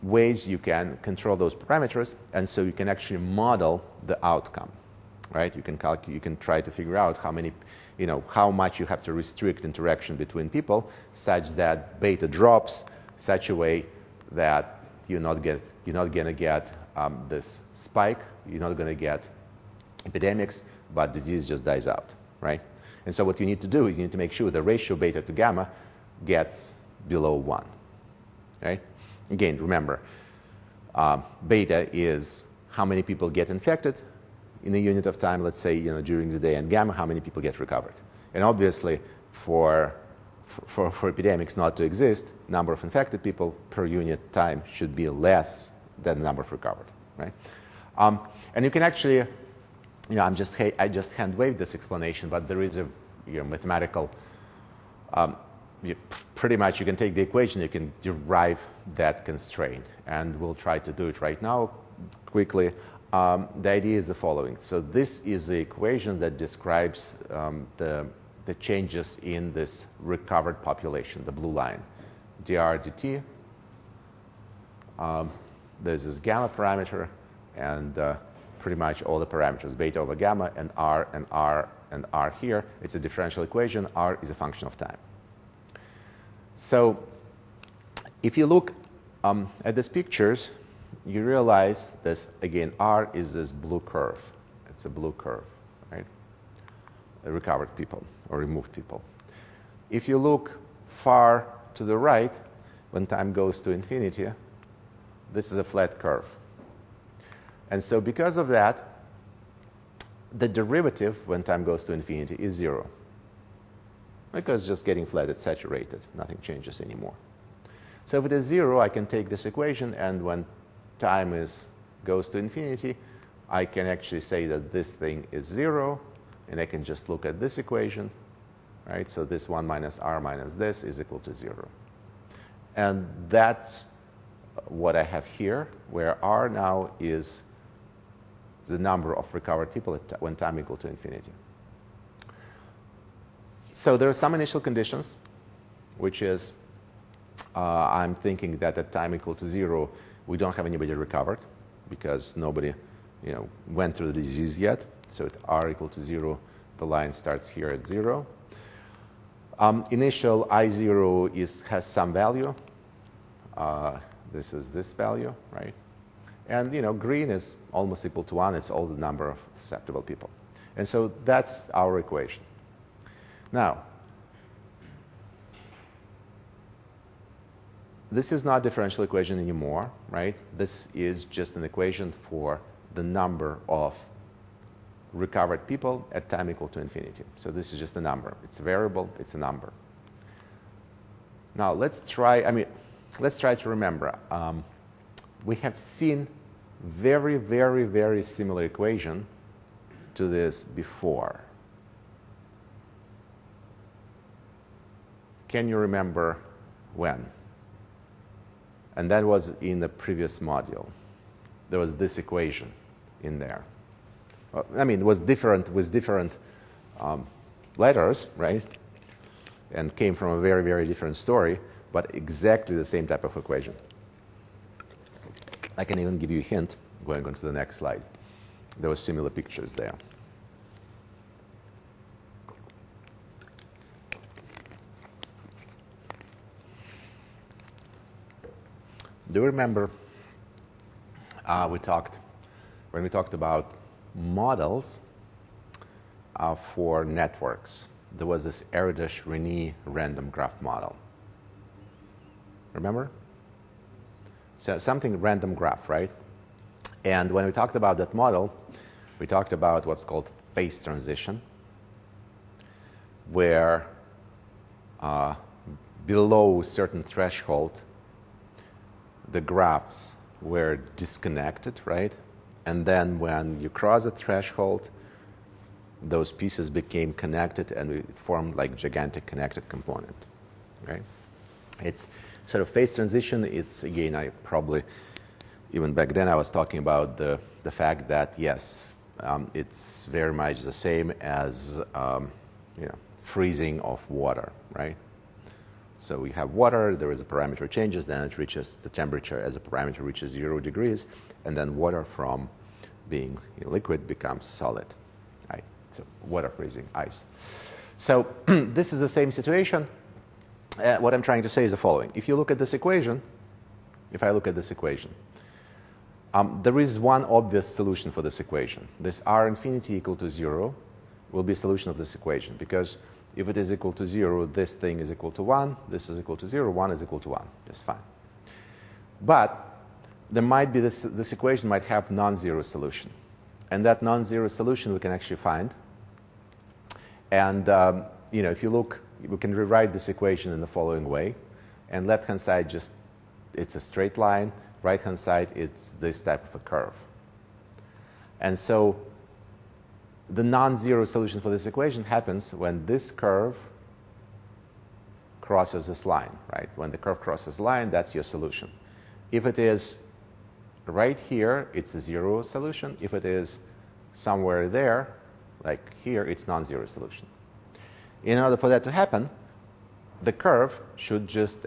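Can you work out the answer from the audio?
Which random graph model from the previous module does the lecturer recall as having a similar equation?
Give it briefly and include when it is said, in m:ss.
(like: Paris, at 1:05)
Erdos Renyi, at 4:08.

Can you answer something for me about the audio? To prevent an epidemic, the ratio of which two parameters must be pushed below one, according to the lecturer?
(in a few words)
beta to gamma.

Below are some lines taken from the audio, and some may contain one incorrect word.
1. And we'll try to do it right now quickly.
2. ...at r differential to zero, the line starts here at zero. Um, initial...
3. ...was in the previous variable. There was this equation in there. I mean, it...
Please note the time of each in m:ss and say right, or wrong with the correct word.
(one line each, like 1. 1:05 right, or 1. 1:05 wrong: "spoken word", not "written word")
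1. 1:00 right
2. 2:35 wrong: "equal", not "differential"
3. 3:29 wrong: "module", not "variable".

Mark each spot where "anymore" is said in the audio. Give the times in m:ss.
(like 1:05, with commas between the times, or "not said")
1:56, 2:59.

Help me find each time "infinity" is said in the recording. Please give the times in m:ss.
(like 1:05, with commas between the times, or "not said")
1:43, 1:51, 2:02, 2:20, 3:06, 5:19.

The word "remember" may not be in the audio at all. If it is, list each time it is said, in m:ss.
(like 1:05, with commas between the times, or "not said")
0:29, 3:13, 3:25, 3:59, 4:12.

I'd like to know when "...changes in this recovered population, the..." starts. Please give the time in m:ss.
1:08.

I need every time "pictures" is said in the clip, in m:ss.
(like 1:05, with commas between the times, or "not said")
1:29, 3:49.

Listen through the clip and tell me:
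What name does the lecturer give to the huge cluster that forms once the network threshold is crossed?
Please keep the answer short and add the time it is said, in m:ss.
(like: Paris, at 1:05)
gigantic connected component, at 4:38.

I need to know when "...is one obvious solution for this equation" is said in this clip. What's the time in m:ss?
5:16.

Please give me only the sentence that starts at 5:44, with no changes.
Right-hand side, it's this type of a curve.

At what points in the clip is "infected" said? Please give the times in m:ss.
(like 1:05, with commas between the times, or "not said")
0:33, 0:42.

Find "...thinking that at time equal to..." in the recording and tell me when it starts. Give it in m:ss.
2:28.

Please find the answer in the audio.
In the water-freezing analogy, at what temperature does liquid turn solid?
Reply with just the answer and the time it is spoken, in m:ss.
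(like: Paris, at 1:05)
zero degrees, at 5:00.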